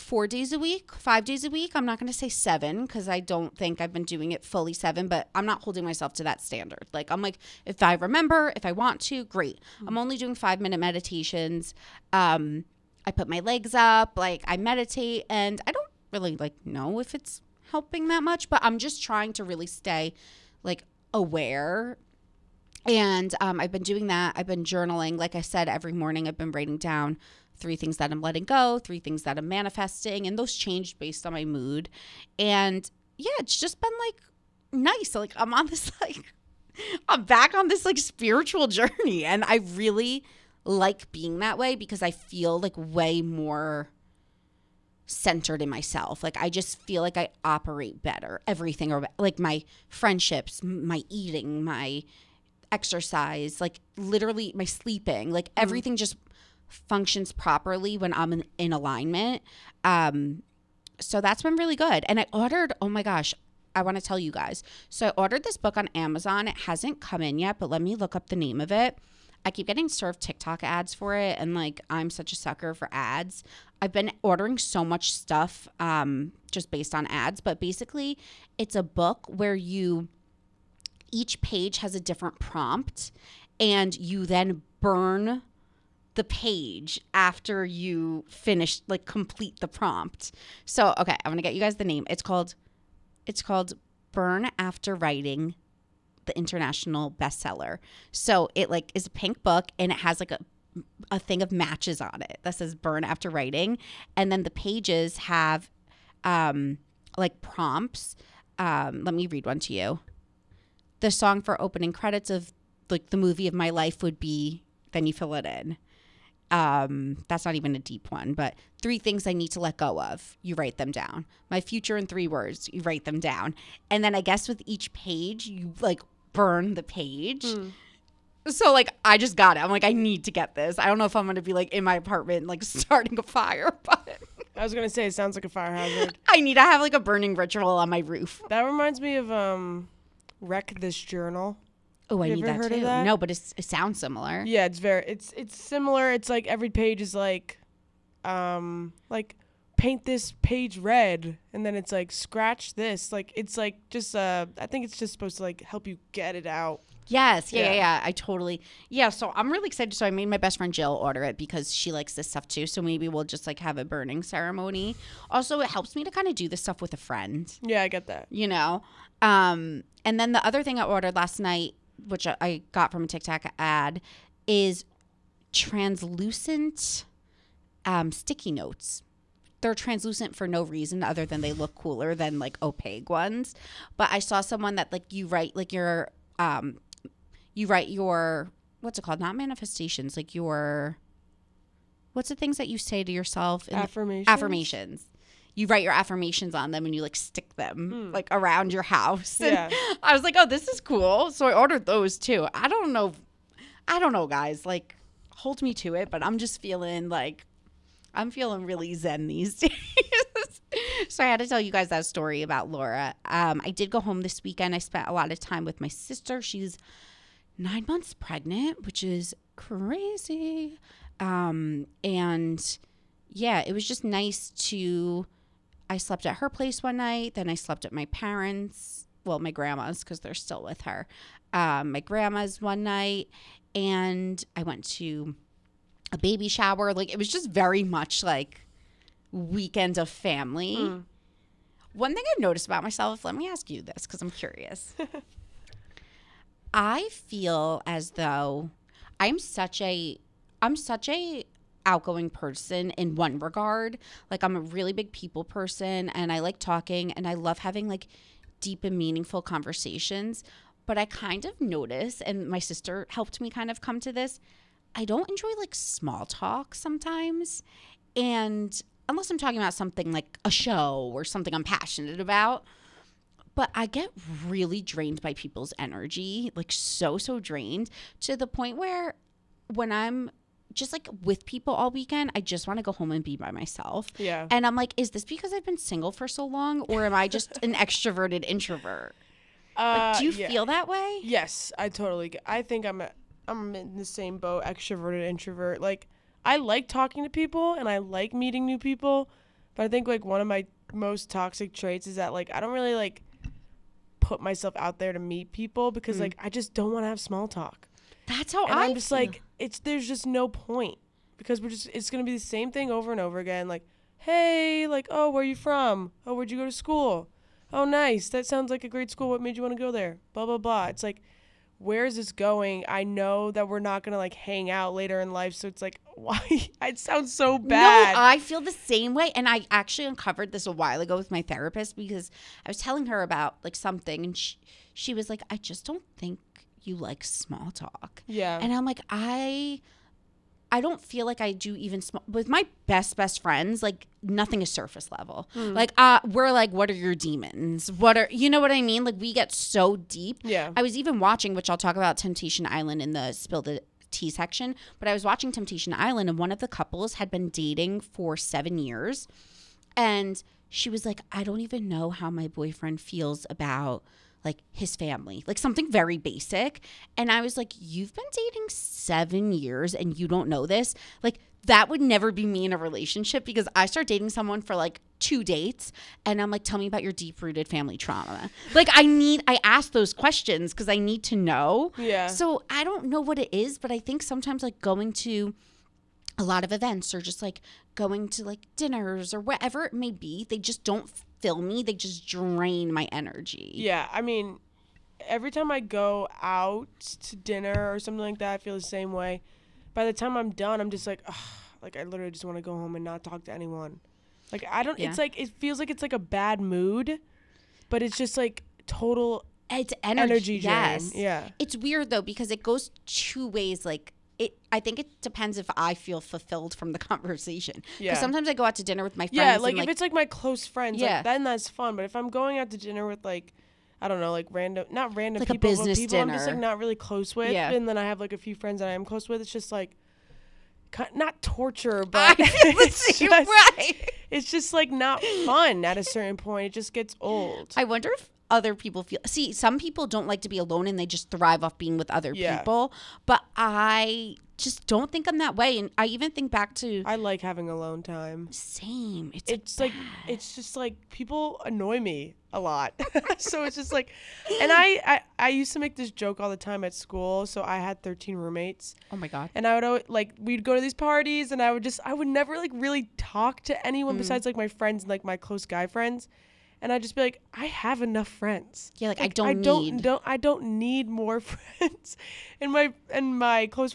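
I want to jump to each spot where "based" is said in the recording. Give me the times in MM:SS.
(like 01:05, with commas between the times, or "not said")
00:30, 01:16.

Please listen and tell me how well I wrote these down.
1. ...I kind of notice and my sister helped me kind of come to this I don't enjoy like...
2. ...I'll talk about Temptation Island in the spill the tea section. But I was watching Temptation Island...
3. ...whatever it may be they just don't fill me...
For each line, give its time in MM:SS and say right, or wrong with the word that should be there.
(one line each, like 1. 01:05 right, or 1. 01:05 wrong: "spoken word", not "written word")
1. 04:20 right
2. 05:51 right
3. 06:29 right.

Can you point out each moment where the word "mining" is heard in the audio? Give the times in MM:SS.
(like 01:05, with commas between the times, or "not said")
not said.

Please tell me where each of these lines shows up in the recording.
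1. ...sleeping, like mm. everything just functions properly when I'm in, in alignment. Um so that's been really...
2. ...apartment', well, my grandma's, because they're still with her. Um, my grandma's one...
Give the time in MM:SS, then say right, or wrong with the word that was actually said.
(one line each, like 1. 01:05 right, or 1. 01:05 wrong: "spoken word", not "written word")
1. 00:54 right
2. 03:48 wrong: "parents", not "apartment".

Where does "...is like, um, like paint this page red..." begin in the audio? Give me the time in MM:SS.
02:27.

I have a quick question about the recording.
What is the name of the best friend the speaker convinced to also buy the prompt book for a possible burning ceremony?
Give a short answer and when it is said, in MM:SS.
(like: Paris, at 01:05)
Jill, at 02:40.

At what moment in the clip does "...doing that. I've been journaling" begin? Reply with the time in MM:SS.
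00:23.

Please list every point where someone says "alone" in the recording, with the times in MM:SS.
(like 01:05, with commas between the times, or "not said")
07:20, 07:27.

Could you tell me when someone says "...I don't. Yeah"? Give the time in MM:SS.
06:44.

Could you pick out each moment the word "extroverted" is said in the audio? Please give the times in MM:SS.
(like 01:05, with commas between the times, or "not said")
04:47, 04:54.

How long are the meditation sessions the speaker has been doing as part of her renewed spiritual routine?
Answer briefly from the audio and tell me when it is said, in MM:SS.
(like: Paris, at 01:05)
5 minutes, at 00:10.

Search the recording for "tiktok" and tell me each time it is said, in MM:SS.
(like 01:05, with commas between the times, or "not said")
01:10, 02:53.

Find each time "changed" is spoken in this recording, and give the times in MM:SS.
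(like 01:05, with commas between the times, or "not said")
00:30.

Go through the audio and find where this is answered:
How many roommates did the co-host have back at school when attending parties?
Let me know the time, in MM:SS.
07:38.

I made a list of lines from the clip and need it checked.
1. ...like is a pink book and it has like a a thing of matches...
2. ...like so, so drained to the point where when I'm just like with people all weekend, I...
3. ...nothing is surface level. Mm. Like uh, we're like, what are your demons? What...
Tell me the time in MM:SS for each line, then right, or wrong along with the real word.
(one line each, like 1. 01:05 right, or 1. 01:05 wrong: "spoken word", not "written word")
1. 01:38 right
2. 04:36 right
3. 05:44 right.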